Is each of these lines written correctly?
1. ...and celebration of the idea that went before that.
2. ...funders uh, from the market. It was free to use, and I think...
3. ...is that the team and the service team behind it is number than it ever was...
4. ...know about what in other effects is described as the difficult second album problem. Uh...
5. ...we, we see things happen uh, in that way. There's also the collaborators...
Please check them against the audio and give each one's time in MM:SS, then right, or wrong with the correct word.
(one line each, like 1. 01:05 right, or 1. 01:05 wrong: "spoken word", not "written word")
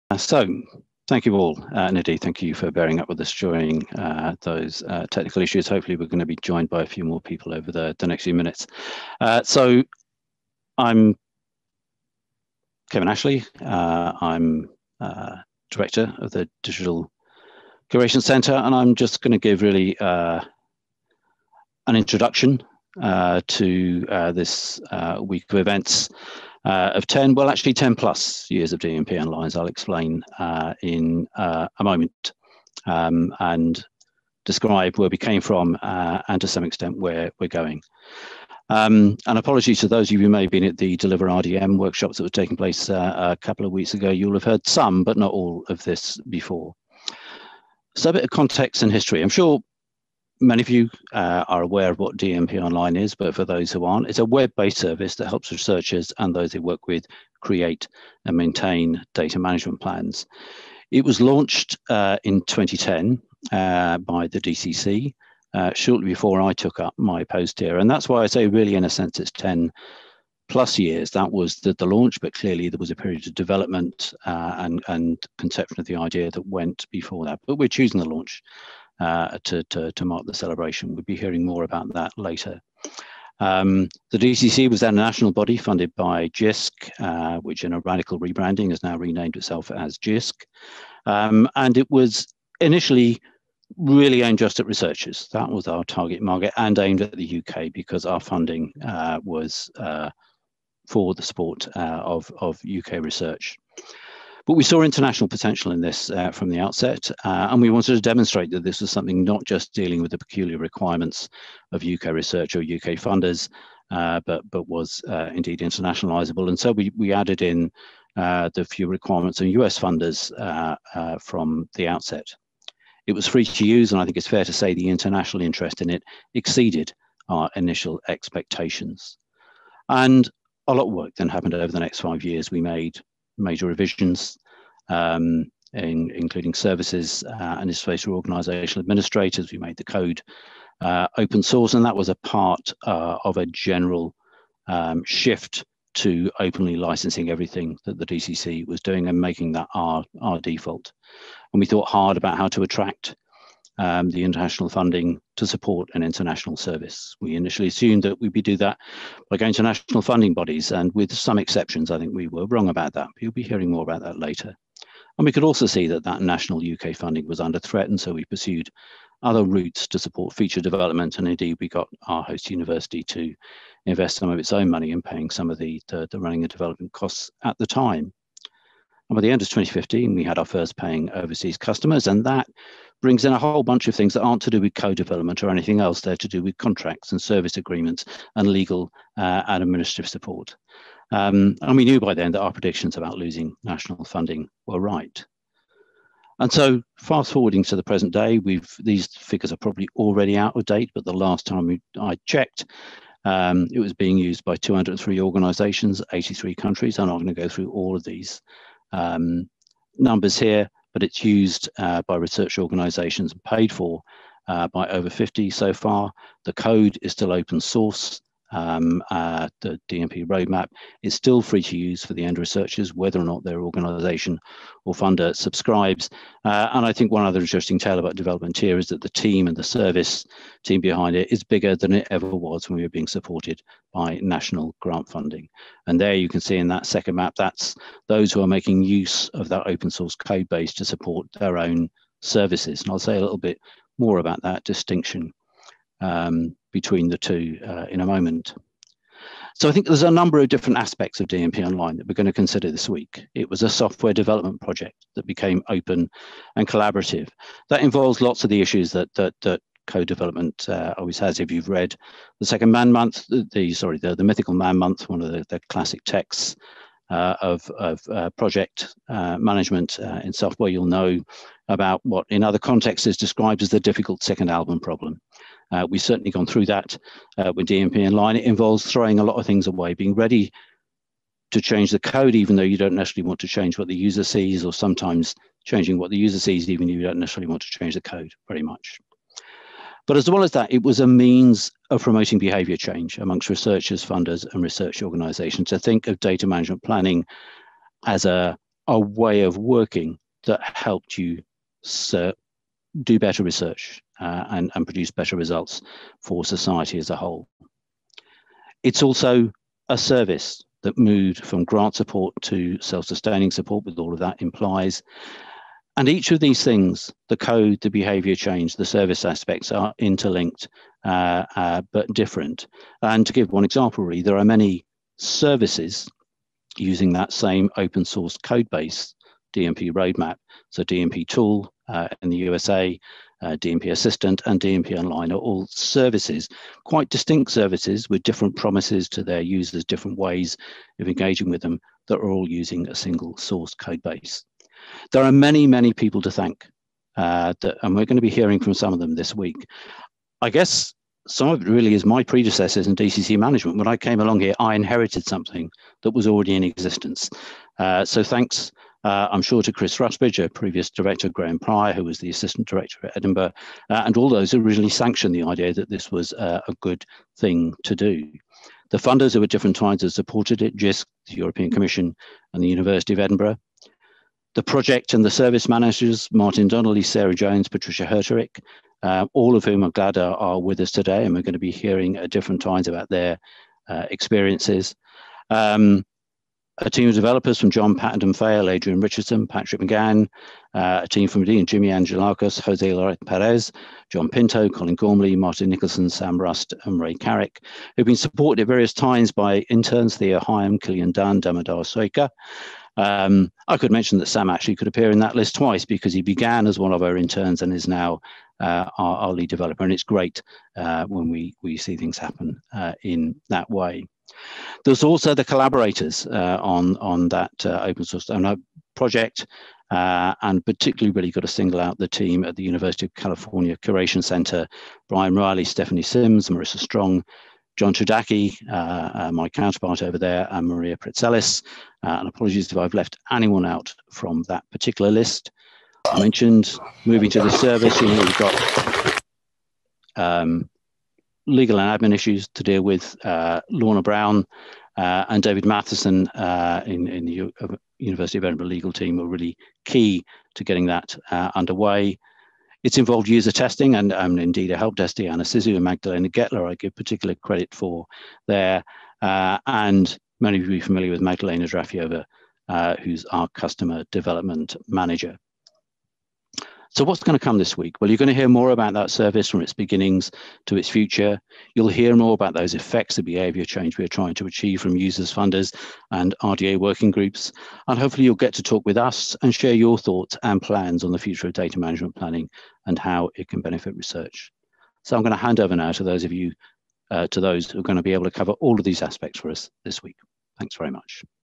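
1. 01:14 wrong: "conception", not "celebration"
2. 01:59 wrong: "outset", not "market"
3. 03:48 wrong: "bigger", not "number"
4. 04:30 wrong: "contexts", not "effects"
5. 06:51 right.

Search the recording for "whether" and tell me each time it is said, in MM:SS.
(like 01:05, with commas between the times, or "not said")
03:42.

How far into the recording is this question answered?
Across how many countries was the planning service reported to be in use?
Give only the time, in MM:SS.
03:26.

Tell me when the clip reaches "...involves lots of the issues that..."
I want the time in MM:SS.
04:17.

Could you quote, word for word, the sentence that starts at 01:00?
It was launched uh, in 2010 uh, by the DCC, uh, shortly before I took up my post here.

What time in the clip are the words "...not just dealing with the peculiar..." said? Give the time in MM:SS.
01:49.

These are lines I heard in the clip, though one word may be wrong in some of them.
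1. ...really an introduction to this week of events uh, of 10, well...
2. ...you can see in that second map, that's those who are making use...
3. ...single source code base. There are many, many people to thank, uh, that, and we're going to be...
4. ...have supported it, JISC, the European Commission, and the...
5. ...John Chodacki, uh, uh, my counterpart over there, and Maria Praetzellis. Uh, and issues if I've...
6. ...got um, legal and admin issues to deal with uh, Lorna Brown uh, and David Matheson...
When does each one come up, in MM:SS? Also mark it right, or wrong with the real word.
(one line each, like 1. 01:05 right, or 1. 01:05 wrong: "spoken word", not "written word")
1. 00:19 right
2. 03:56 right
3. 05:42 right
4. 06:10 right
5. 07:07 wrong: "apologies", not "issues"
6. 07:18 right.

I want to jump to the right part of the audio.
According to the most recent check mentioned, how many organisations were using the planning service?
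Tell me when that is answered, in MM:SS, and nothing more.
03:24.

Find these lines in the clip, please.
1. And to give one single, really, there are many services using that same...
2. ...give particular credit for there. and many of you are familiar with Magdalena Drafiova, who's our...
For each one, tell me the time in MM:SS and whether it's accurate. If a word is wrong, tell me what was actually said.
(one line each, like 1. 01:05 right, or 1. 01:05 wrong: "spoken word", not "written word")
1. 05:23 wrong: "example", not "single"
2. 07:36 right.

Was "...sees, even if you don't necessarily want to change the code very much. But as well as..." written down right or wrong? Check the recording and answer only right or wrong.
right.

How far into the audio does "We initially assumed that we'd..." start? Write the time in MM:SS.
02:37.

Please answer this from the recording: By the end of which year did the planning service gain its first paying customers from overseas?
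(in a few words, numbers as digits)
2015.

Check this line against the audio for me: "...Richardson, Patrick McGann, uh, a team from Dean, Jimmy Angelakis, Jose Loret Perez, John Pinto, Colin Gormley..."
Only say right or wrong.
right.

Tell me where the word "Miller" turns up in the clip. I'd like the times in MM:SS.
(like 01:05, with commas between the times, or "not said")
not said.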